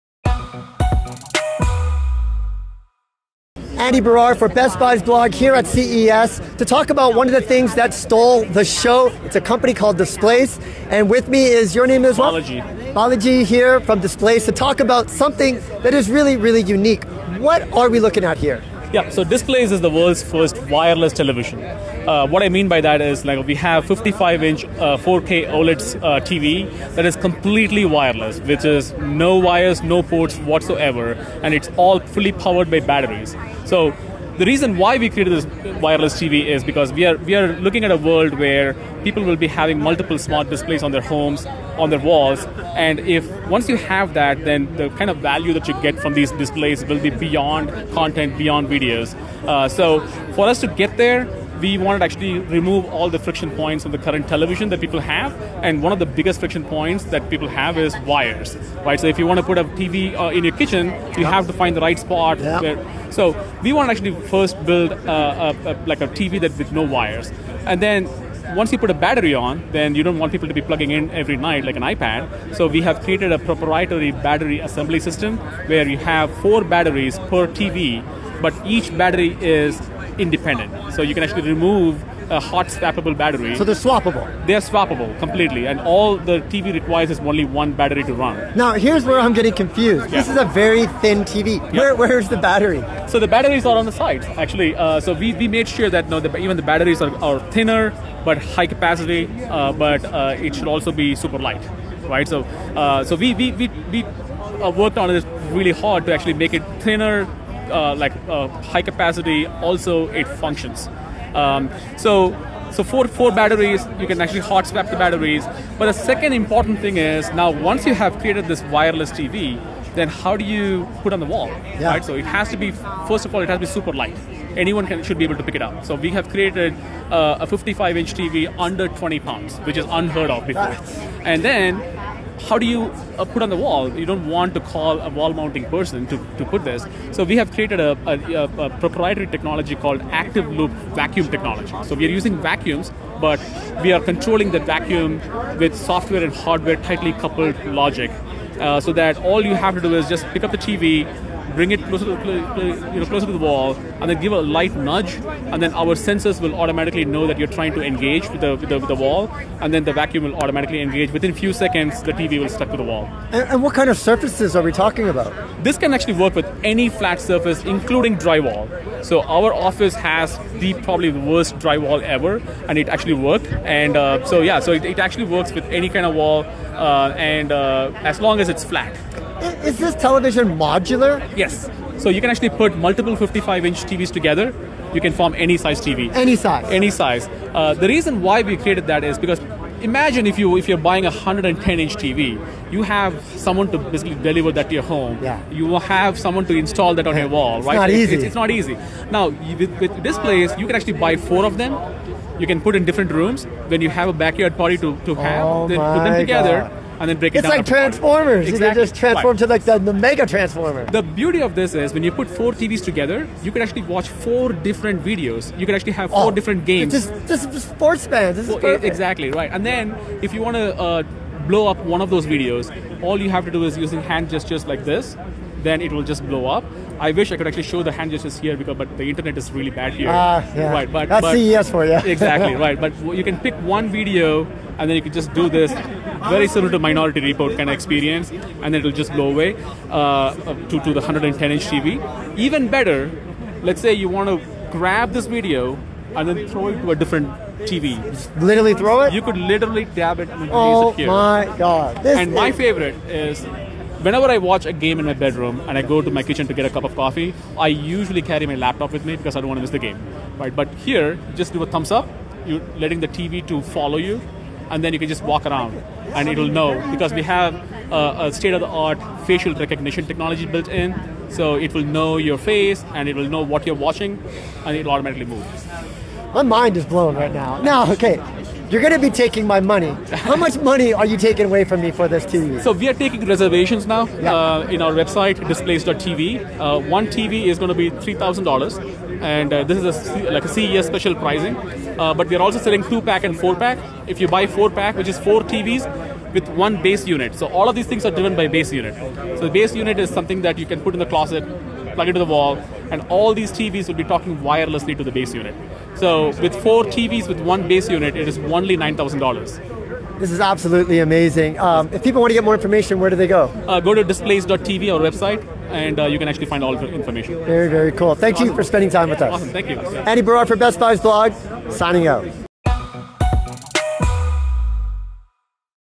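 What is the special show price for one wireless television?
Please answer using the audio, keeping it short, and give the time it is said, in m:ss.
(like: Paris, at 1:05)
$3,000, at 4:47.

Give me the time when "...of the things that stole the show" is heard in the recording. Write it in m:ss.
0:07.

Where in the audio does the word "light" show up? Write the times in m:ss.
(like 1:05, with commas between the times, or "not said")
1:41, 2:03, 2:34.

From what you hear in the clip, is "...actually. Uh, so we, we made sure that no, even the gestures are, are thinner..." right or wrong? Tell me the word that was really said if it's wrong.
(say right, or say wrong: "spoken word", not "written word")
wrong: "batteries", not "gestures".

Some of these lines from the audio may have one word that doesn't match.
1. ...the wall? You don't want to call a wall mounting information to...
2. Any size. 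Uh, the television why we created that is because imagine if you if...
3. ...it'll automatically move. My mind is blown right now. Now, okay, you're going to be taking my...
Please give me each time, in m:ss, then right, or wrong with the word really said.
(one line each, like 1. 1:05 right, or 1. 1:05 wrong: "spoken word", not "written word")
1. 2:13 wrong: "person", not "information"
2. 3:06 wrong: "reason", not "television"
3. 4:34 right.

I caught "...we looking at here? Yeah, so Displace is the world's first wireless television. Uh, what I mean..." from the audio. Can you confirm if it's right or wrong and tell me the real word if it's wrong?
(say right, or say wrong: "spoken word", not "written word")
right.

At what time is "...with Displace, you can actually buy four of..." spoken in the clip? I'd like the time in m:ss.
3:19.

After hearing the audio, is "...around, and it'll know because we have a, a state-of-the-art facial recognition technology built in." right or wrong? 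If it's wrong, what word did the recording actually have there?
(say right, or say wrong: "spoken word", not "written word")
right.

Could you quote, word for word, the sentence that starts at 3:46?
I wish I could actually show the hand gestures here because but the internet is really bad here.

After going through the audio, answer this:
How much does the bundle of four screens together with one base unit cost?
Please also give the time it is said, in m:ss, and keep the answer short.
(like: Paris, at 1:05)
$9,000, at 5:08.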